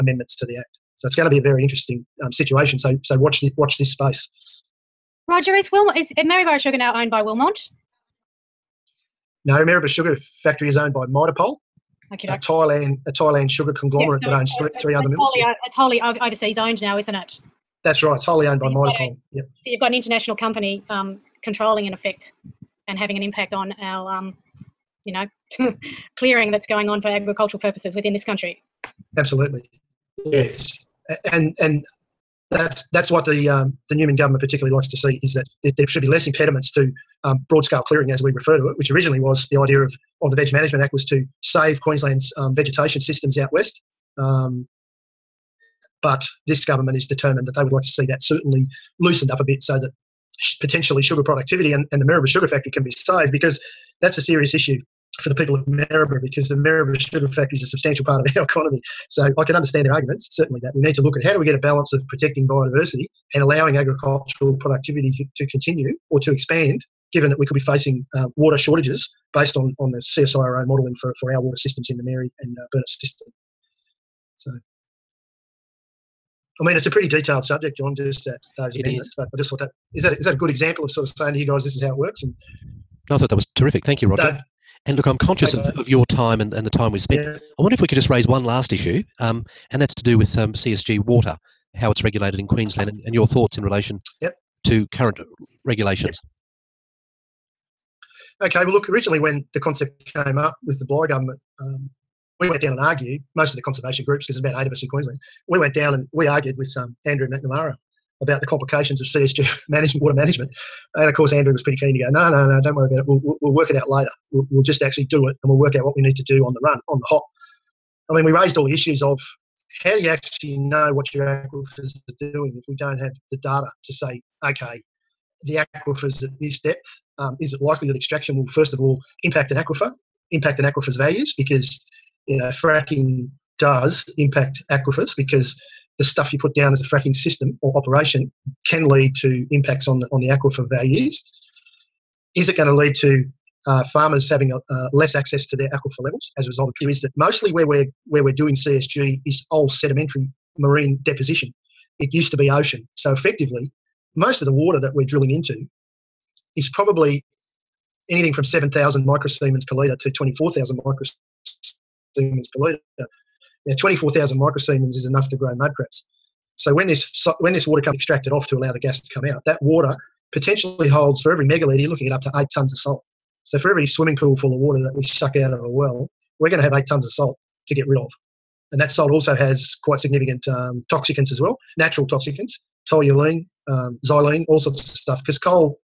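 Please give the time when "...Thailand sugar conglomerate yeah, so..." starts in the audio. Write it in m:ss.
0:13.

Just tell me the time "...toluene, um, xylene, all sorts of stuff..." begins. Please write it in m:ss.
3:02.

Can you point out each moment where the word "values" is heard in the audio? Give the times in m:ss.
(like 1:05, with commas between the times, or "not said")
2:10, 2:20.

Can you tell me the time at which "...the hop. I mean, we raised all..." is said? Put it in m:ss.
1:56.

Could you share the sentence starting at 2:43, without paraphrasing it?
Now, 24,000 microsiemens is enough to grow mud crabs.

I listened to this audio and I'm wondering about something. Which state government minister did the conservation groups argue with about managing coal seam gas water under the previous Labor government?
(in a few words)
Andrew McNamara.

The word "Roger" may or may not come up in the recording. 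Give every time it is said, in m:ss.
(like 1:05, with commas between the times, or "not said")
0:05, 1:24.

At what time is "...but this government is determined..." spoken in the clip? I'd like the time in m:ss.
0:46.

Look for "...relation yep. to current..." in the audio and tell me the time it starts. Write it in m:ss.
1:33.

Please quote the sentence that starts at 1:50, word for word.
And of course, Andrew was pretty keen to go, no, no, no, don't worry about it.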